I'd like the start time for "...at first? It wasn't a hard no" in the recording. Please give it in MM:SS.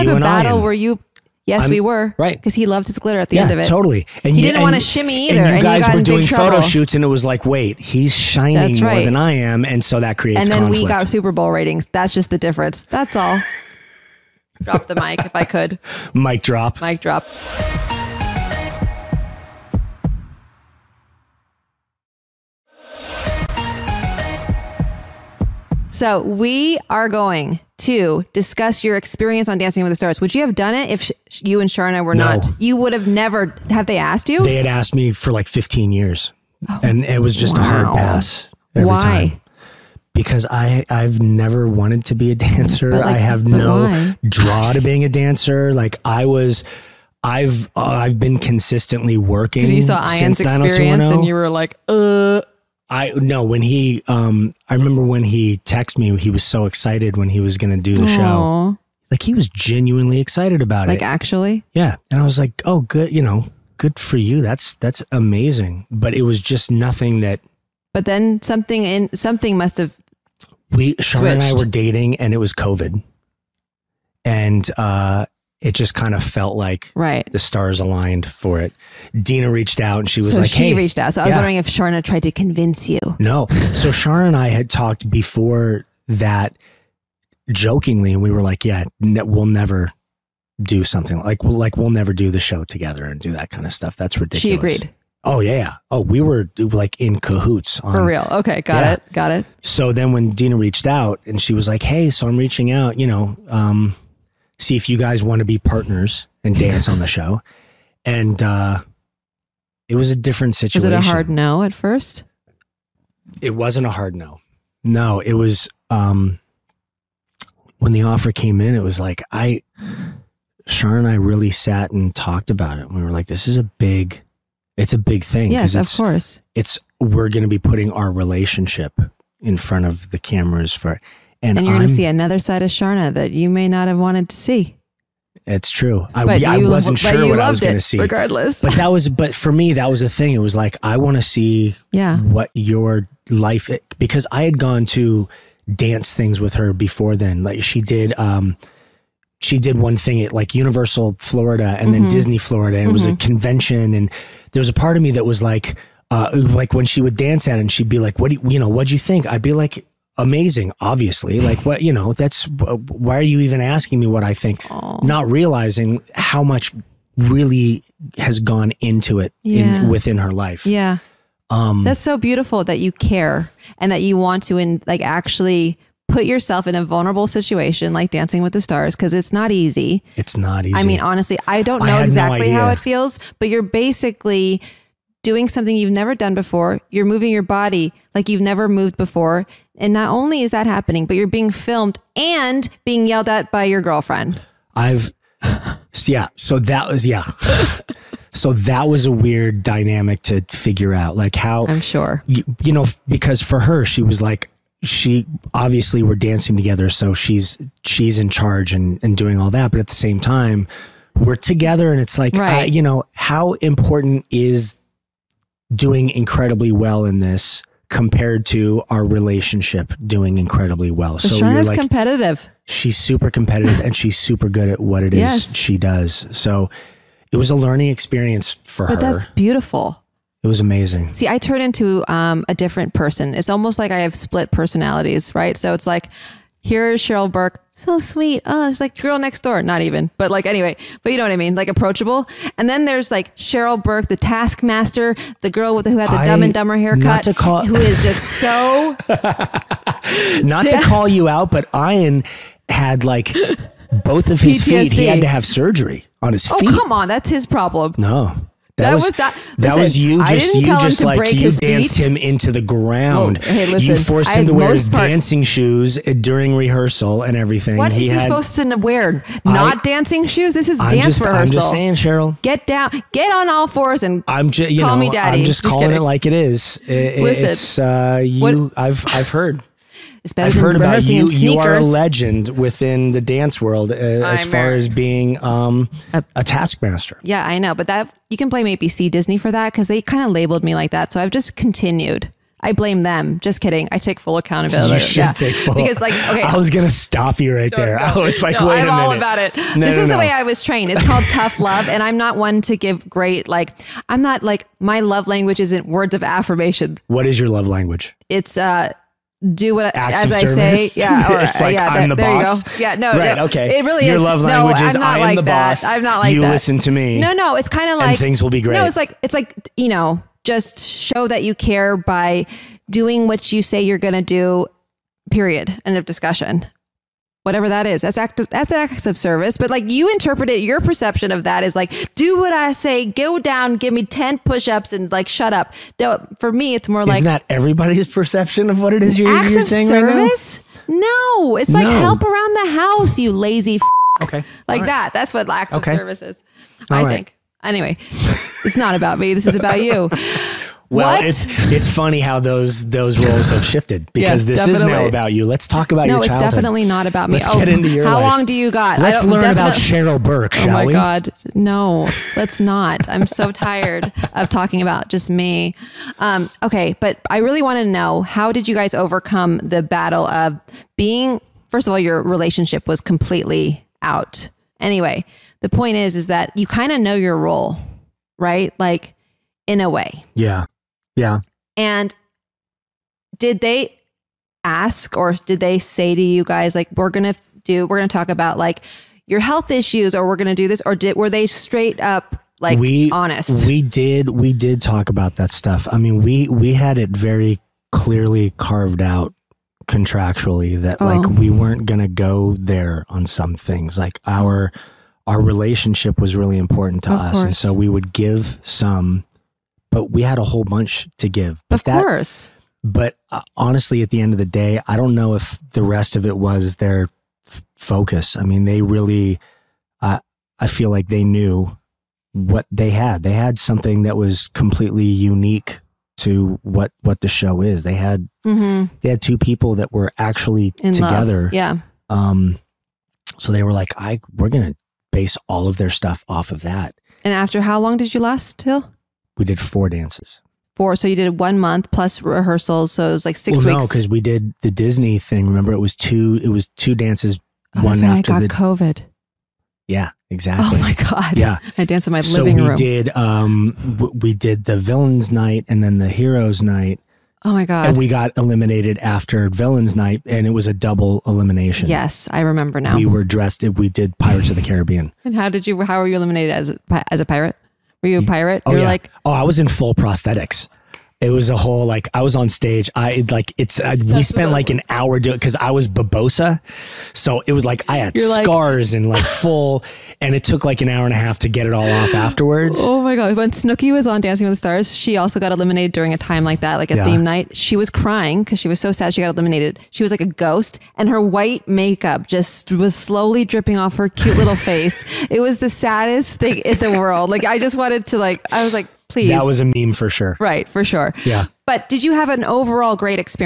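01:51.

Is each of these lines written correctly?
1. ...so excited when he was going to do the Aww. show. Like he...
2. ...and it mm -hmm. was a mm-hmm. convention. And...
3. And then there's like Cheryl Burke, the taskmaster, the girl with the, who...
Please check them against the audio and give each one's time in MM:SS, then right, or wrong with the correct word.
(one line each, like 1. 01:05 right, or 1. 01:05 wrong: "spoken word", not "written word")
1. 00:56 right
2. 02:32 right
3. 04:02 right.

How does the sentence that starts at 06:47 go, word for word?
and so we would give some but we had a whole bunch to give.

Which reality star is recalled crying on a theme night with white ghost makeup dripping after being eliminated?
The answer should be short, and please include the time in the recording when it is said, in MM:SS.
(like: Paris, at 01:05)
Snooki, at 08:03.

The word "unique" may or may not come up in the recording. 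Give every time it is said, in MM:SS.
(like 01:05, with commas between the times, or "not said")
07:05.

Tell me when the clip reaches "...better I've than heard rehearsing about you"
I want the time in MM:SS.
04:40.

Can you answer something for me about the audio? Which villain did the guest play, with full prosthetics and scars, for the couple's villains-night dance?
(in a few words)
Barbossa.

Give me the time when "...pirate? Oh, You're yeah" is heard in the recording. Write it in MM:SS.
07:48.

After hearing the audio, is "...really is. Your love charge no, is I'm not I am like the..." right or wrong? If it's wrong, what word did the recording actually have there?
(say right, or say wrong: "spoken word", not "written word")
wrong: "language", not "charge".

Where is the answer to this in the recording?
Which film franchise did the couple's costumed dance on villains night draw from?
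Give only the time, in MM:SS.
07:44.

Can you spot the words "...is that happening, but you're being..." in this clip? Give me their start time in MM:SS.
03:10.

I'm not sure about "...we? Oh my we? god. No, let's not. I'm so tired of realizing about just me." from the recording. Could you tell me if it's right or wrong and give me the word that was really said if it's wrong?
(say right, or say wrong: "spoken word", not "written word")
wrong: "talking", not "realizing".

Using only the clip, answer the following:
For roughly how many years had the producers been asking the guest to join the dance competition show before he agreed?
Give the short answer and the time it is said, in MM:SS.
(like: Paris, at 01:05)
15, at 00:35.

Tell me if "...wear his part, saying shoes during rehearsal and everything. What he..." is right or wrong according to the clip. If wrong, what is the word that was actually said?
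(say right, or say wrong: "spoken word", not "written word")
wrong: "dancing", not "saying".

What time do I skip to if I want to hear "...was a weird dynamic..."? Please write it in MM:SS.
03:18.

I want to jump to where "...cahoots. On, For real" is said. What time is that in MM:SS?
01:37.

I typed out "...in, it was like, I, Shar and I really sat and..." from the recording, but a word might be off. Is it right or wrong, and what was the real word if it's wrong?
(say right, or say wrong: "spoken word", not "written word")
right.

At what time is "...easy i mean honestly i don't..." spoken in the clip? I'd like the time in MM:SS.
03:00.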